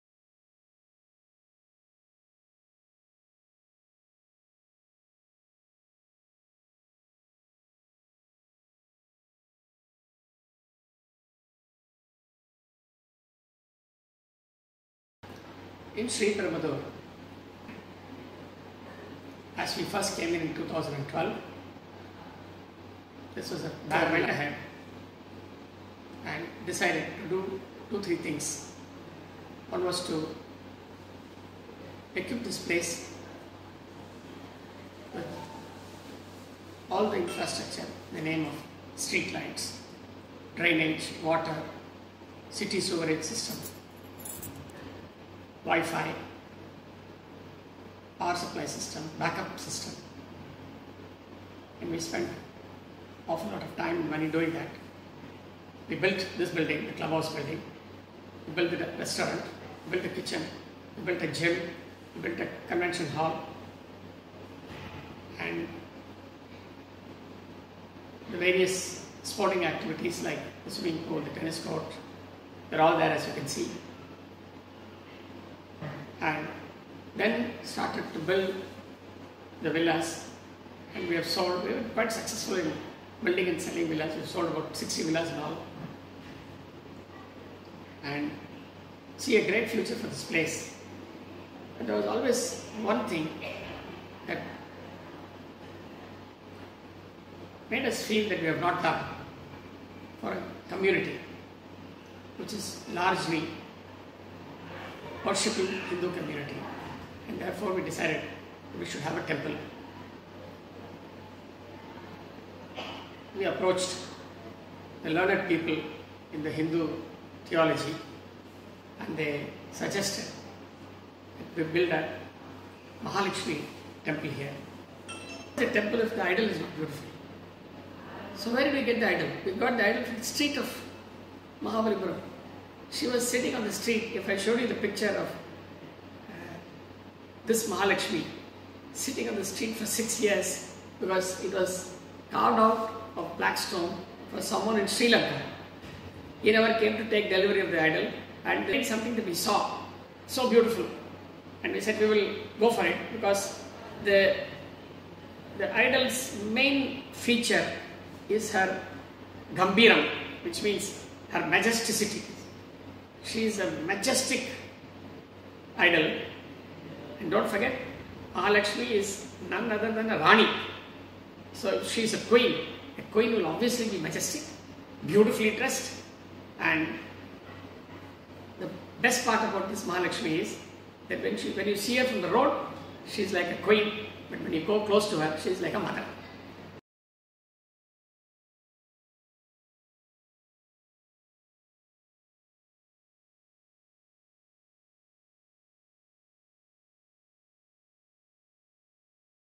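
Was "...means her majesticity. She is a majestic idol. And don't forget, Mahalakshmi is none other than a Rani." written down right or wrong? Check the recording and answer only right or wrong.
right.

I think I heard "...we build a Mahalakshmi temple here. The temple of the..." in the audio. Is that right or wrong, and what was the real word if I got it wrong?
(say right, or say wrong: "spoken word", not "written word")
right.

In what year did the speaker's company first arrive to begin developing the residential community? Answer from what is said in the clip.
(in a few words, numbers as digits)
2012.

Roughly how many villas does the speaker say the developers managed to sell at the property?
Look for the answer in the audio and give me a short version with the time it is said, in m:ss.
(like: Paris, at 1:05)
60, at 1:24.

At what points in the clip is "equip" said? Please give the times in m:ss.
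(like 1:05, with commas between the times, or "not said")
0:32.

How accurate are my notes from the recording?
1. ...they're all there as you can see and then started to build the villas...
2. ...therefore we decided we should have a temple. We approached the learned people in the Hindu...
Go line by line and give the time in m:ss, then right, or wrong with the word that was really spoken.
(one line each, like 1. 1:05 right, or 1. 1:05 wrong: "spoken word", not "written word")
1. 1:12 right
2. 1:47 right.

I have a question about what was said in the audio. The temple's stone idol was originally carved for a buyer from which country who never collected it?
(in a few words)
Sri Lanka.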